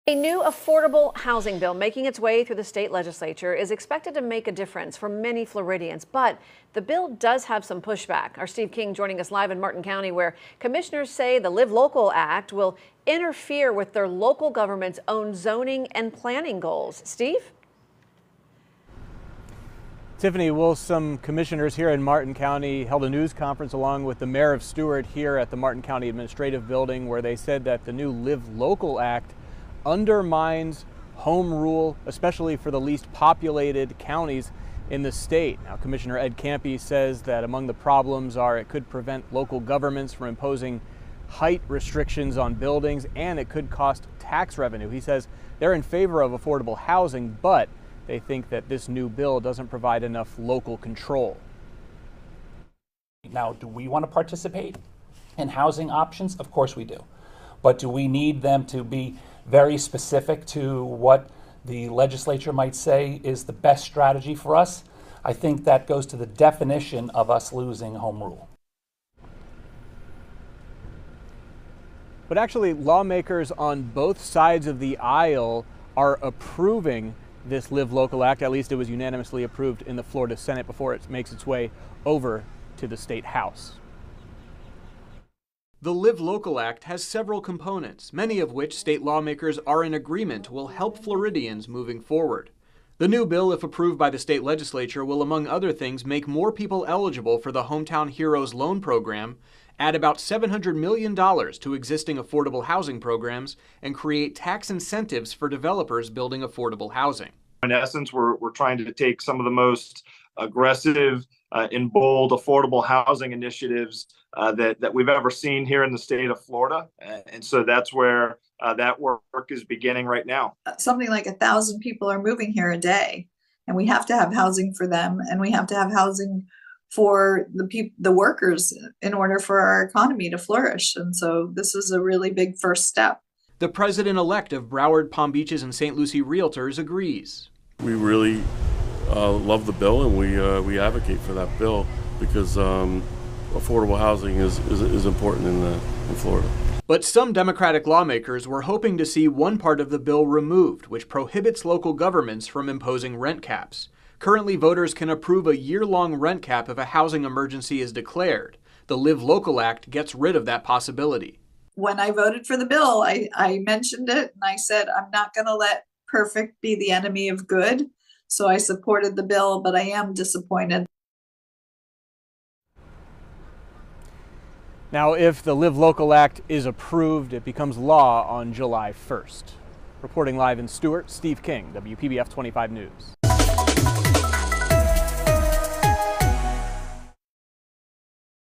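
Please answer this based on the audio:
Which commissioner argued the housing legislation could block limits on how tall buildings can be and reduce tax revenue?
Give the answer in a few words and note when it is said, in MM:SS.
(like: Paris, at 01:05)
Ed Ciampi, at 00:36.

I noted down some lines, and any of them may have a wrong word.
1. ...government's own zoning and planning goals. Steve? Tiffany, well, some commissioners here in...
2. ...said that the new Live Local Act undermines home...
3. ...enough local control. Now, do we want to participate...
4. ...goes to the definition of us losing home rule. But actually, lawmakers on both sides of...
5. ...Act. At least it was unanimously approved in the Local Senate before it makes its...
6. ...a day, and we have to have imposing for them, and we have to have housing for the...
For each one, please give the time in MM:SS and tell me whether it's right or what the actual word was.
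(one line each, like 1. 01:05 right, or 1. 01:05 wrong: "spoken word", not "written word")
1. 00:14 right
2. 00:27 right
3. 00:50 right
4. 01:05 right
5. 01:18 wrong: "Florida", not "Local"
6. 02:02 wrong: "housing", not "imposing".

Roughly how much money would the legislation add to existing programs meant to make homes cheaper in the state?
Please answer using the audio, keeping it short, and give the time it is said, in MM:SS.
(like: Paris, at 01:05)
$700 million, at 01:40.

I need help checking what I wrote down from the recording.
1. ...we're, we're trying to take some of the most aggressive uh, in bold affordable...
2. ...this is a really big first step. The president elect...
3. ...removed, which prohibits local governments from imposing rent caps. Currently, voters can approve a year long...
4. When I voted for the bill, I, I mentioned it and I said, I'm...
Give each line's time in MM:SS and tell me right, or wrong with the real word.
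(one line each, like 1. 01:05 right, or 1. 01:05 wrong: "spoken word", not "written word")
1. 01:48 right
2. 02:11 right
3. 02:30 right
4. 02:41 right.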